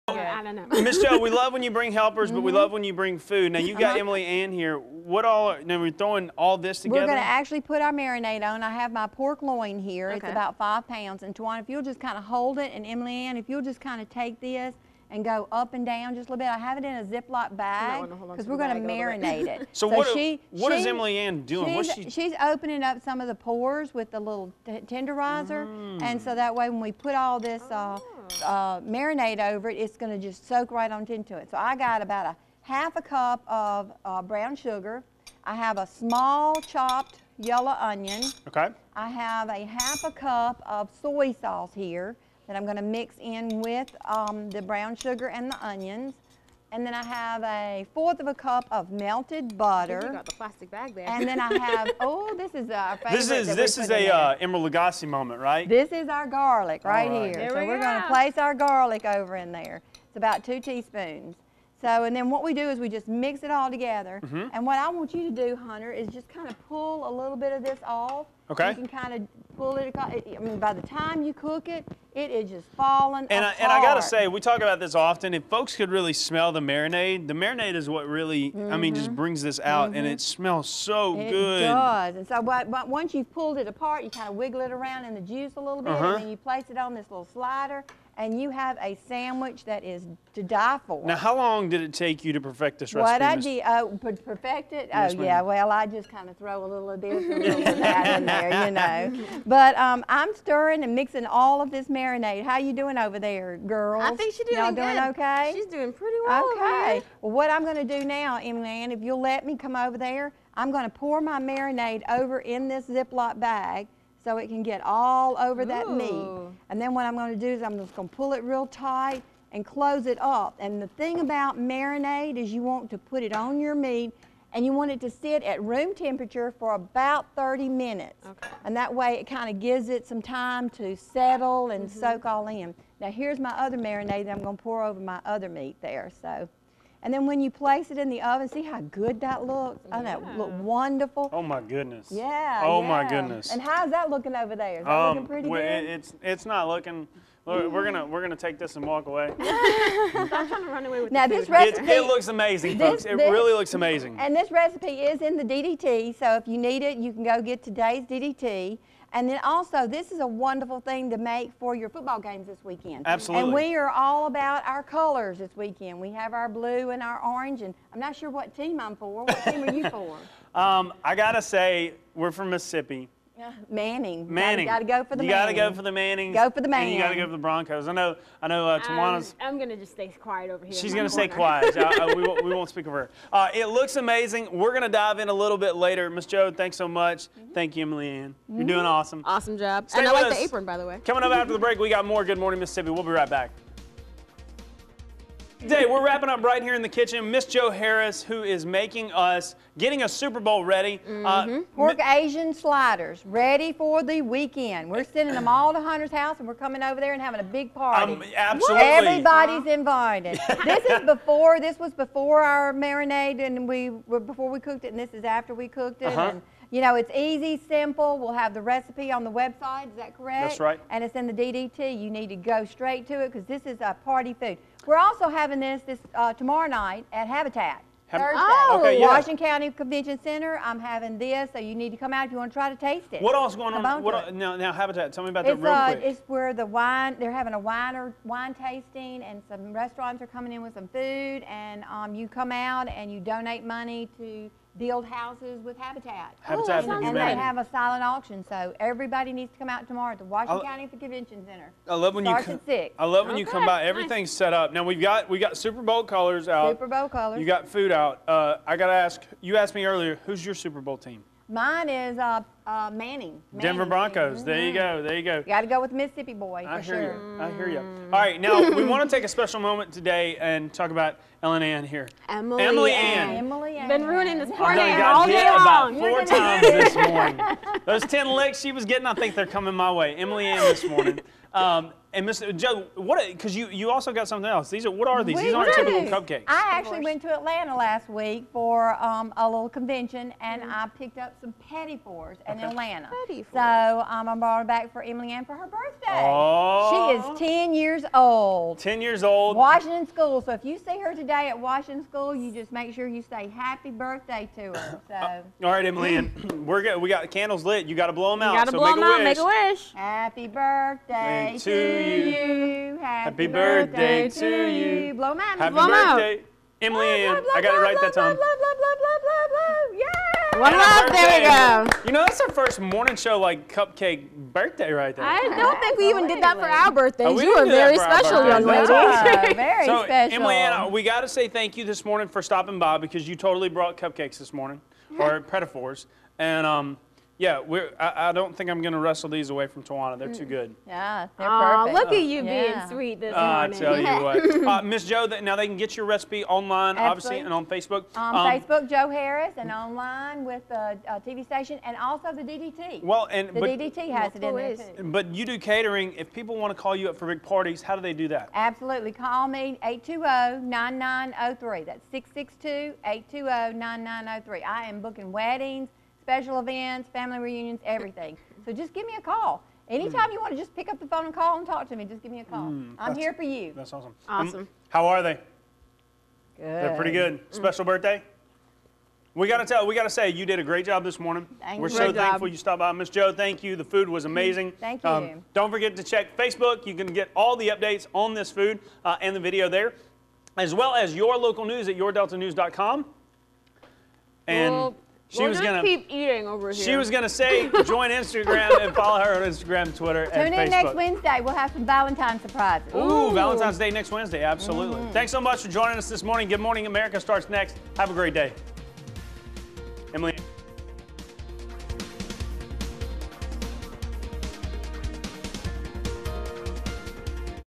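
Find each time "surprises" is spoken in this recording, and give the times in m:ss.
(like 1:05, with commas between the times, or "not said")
6:42.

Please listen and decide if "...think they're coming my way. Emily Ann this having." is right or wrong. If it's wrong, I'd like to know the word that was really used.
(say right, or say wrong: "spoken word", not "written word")
wrong: "morning", not "having".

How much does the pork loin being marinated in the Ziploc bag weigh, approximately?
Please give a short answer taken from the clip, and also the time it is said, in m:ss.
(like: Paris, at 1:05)
5 pounds, at 0:10.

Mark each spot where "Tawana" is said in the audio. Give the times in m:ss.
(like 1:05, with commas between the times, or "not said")
0:11, 2:58, 5:39.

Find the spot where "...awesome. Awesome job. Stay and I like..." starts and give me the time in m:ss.
3:08.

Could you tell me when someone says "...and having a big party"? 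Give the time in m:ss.
3:27.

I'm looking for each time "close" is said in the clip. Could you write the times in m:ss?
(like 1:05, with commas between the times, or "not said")
1:59.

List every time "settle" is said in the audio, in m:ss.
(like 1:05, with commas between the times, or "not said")
2:10.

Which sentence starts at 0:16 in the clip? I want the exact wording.
I have it in a Ziploc bag because we're going to marinate it.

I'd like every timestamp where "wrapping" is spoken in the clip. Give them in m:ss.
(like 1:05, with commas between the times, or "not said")
3:16.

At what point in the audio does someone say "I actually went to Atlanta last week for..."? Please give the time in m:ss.
4:46.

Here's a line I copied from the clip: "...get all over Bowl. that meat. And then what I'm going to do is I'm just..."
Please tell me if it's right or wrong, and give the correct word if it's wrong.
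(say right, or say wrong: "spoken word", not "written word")
wrong: "Ooh", not "Bowl".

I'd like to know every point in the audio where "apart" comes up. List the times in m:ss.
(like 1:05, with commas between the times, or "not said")
1:13, 1:23.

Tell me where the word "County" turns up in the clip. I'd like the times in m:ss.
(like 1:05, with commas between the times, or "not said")
3:49, 4:10.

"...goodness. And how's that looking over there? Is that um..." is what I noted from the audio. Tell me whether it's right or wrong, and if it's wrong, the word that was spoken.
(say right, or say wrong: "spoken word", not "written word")
right.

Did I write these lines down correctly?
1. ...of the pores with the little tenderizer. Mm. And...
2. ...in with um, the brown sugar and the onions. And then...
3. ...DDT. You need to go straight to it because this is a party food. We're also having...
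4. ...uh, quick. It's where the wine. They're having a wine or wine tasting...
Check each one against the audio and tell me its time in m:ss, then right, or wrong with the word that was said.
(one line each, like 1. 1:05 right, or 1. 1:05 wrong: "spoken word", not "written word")
1. 0:23 right
2. 0:43 right
3. 3:41 right
4. 3:55 right.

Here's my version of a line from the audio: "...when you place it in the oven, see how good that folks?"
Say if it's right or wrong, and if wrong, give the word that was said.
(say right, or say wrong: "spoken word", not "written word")
wrong: "looks", not "folks".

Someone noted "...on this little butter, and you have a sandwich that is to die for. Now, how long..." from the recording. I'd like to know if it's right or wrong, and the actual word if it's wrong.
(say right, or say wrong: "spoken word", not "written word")
wrong: "slider", not "butter".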